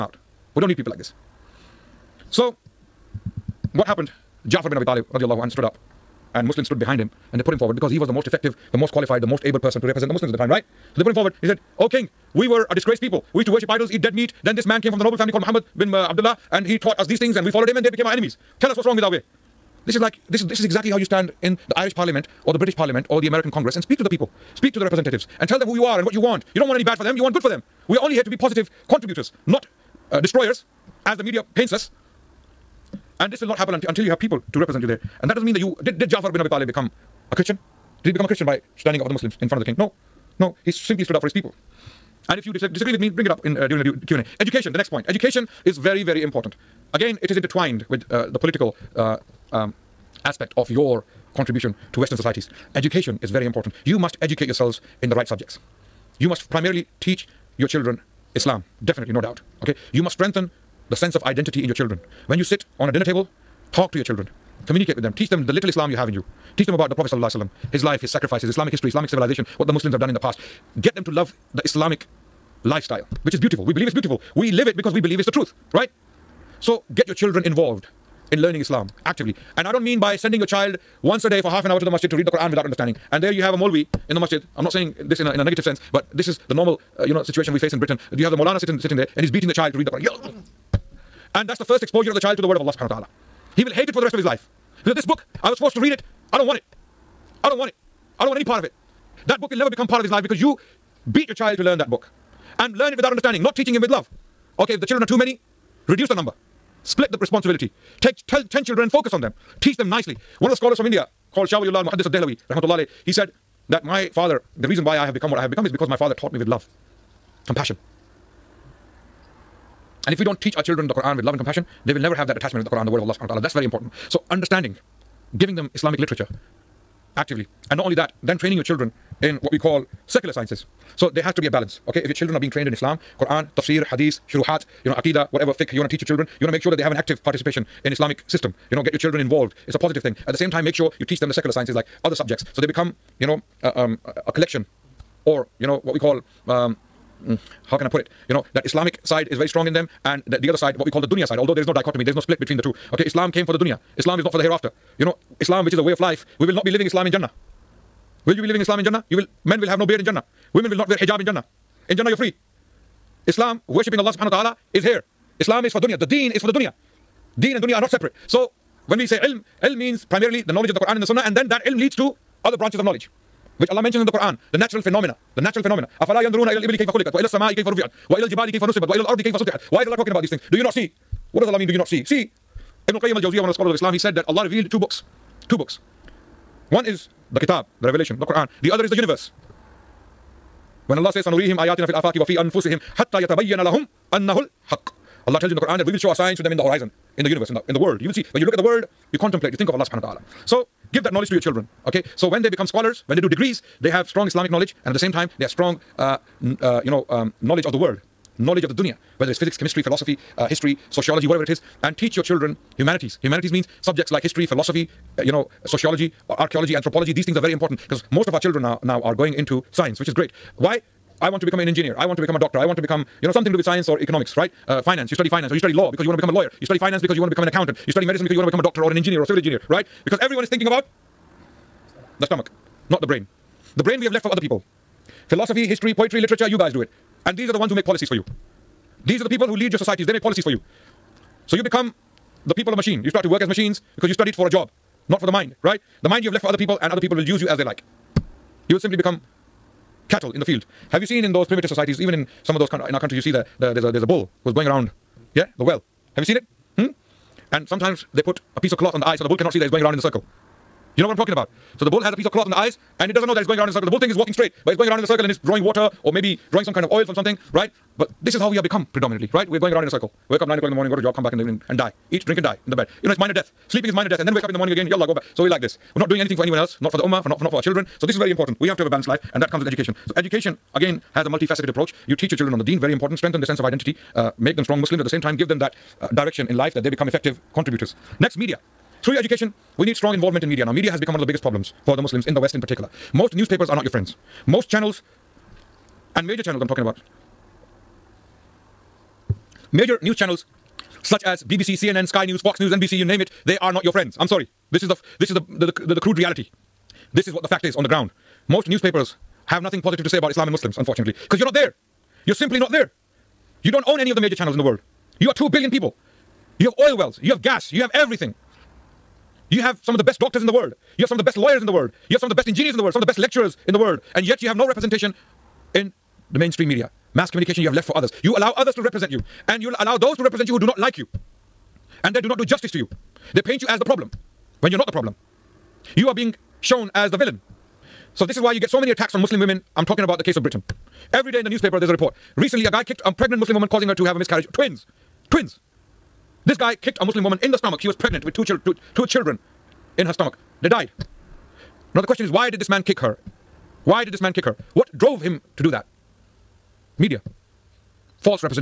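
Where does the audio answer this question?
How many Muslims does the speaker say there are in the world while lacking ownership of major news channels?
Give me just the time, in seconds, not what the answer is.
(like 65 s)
315 s.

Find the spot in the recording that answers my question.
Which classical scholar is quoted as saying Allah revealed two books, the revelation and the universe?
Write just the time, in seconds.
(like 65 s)
182 s.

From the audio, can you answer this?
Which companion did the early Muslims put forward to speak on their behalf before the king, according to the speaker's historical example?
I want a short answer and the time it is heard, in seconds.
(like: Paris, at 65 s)
Ja'far bin Abi Talib, at 4 s.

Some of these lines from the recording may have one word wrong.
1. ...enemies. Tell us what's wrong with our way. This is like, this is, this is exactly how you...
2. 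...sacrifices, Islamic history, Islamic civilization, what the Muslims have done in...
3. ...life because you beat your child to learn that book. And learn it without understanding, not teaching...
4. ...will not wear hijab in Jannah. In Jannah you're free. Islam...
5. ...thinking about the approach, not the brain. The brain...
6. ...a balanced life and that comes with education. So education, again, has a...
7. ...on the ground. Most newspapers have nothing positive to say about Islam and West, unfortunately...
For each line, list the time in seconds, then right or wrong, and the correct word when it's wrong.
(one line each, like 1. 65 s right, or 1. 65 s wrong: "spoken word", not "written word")
1. 18 s right
2. 68 s right
3. 100 s right
4. 160 s right
5. 230 s wrong: "stomach", not "approach"
6. 278 s right
7. 307 s wrong: "Muslims", not "West".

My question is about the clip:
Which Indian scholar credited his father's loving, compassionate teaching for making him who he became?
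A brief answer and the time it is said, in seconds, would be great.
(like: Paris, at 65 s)
Shah Waliullah al Muhaddis al Dehlawi, at 111 s.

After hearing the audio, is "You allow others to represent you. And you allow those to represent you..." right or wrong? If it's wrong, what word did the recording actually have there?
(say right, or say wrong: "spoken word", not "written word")
right.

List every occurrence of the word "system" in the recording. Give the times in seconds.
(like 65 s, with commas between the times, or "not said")
138 s.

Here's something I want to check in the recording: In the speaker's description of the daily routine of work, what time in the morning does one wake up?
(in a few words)
9 o'clock.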